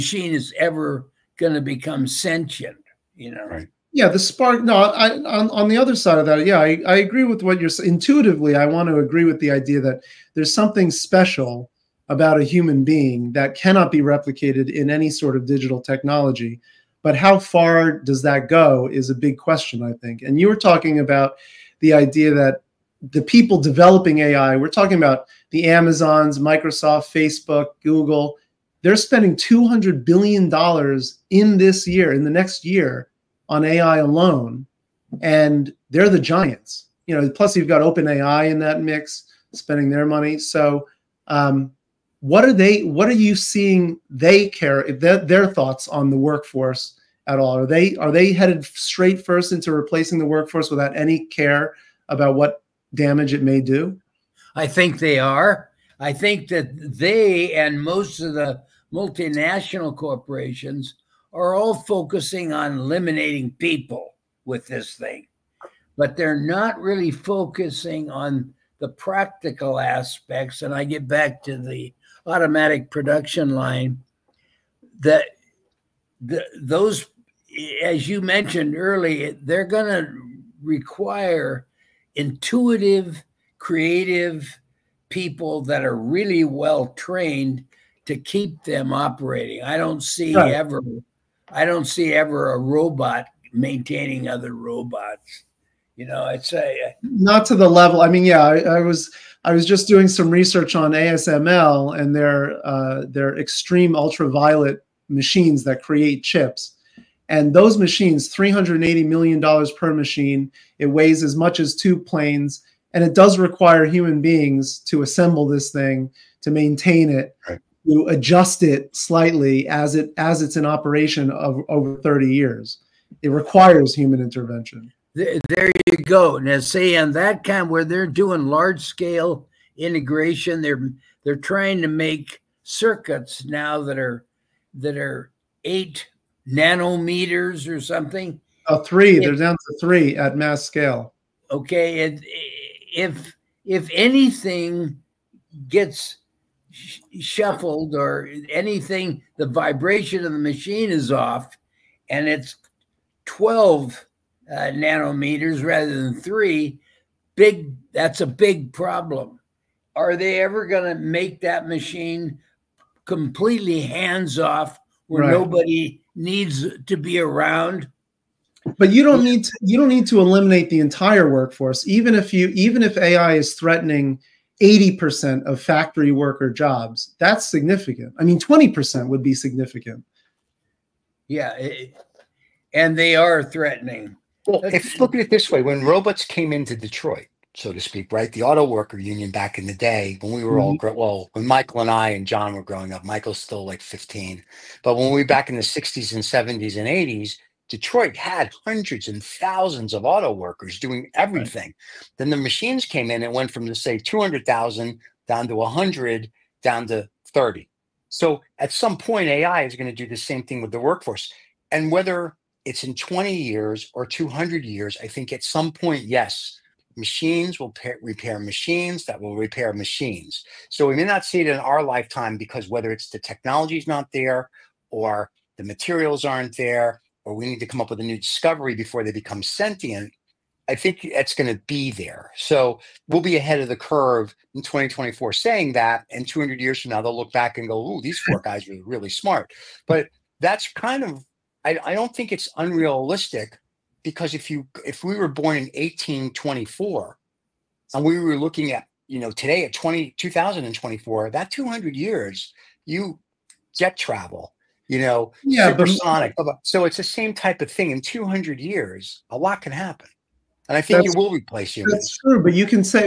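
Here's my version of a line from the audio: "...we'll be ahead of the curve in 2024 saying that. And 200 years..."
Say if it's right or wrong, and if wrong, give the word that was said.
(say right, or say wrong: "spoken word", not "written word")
right.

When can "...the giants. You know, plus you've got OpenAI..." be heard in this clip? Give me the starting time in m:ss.
0:36.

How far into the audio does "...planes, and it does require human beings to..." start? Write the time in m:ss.
1:51.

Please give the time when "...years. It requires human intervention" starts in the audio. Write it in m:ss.
2:02.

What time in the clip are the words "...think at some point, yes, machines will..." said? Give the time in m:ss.
3:35.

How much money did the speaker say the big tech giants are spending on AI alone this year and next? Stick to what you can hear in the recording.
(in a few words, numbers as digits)
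$200 billion.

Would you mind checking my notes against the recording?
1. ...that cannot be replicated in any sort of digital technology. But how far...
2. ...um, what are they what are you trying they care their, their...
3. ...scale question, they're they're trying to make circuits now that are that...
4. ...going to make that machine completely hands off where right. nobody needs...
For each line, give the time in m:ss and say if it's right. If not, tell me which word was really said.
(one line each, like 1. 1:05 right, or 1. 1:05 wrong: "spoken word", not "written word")
1. 0:13 right
2. 0:41 wrong: "seeing", not "trying"
3. 2:08 wrong: "integration", not "question"
4. 2:40 right.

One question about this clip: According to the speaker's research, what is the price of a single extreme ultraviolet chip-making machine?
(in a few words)
$380 million.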